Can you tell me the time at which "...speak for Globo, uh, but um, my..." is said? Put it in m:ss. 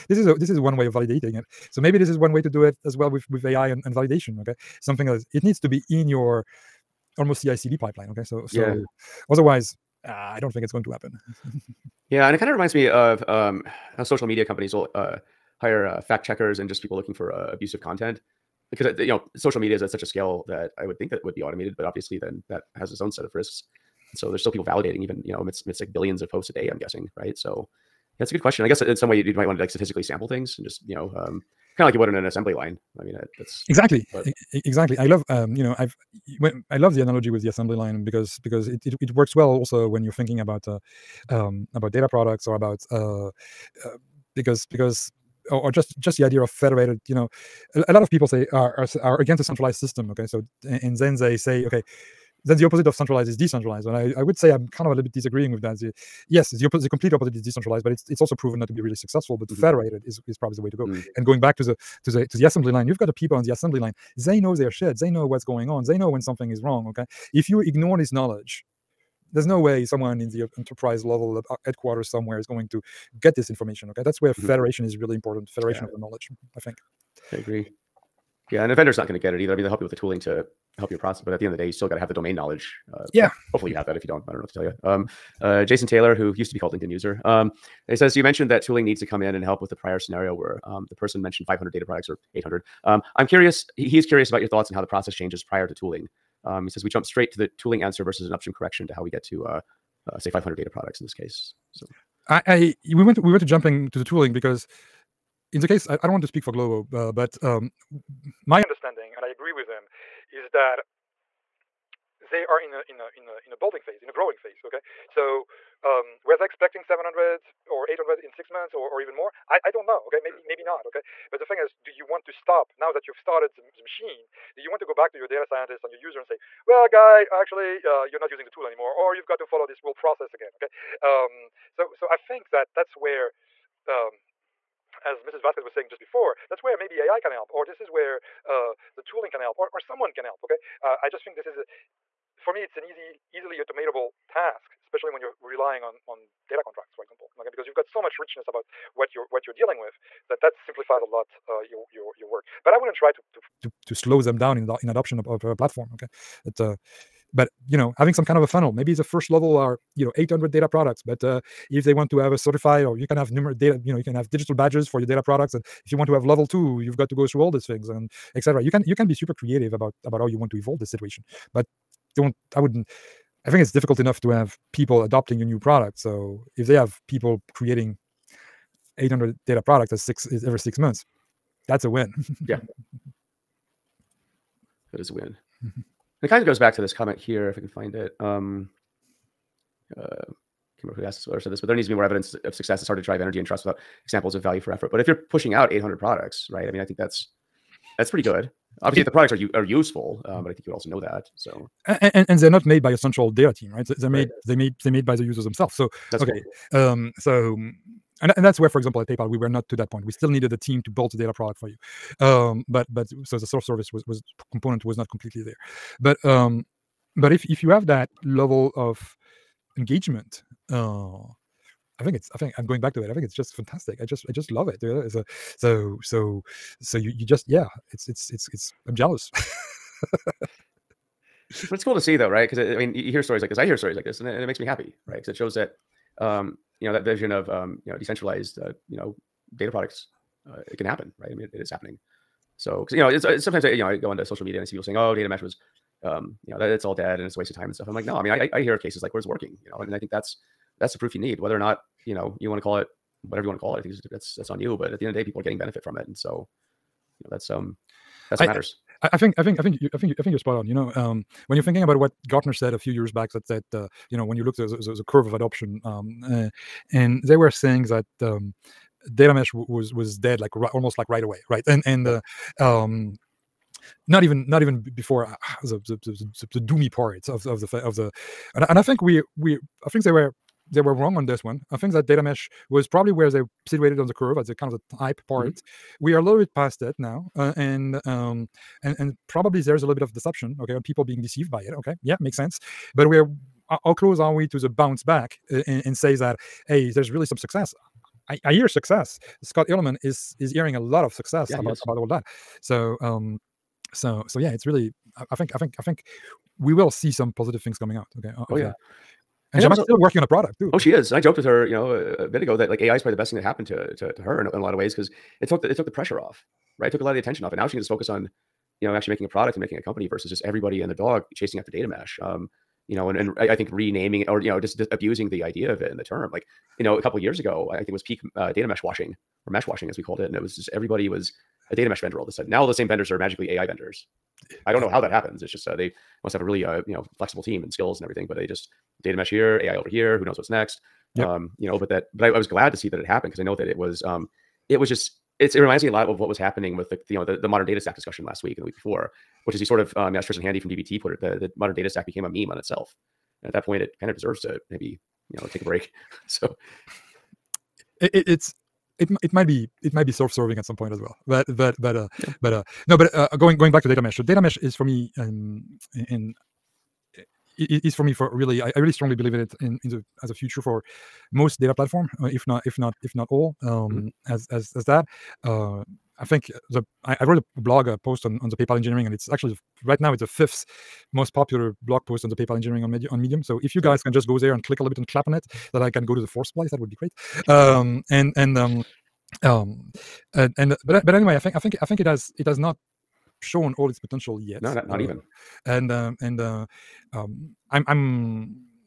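1:46.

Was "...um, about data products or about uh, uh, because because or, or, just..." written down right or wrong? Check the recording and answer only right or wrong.
right.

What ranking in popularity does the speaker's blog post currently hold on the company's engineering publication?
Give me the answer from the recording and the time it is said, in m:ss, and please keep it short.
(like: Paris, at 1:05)
Fifth, at 6:20.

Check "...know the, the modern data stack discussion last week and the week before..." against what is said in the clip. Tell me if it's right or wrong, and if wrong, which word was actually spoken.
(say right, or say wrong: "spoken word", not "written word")
right.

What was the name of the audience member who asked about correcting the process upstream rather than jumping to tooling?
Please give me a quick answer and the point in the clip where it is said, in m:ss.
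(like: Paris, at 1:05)
Jason Taylor, at 1:25.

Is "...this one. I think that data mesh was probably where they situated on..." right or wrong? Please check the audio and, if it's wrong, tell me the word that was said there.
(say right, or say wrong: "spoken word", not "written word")
right.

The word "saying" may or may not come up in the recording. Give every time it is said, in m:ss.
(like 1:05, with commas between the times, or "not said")
2:15, 4:04, 4:27.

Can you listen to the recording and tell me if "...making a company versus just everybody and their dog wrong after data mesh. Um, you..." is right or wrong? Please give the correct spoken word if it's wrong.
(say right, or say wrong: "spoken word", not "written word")
wrong: "chasing", not "wrong".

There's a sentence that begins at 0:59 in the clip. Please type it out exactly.
federated is is probably the way to go.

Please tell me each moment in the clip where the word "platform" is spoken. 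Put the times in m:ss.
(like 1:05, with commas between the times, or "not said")
2:35, 6:11.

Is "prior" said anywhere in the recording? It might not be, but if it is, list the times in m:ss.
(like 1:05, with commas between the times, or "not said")
1:29, 1:35.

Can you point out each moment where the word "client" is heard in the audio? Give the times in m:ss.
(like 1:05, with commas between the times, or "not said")
not said.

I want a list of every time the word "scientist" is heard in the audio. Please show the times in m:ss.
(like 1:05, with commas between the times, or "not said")
2:05.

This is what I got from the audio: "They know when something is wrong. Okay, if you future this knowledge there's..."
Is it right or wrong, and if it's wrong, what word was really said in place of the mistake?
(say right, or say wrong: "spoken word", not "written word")
wrong: "ignore", not "future".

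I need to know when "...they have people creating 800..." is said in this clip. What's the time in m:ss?
2:56.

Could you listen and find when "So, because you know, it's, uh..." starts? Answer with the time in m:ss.
4:02.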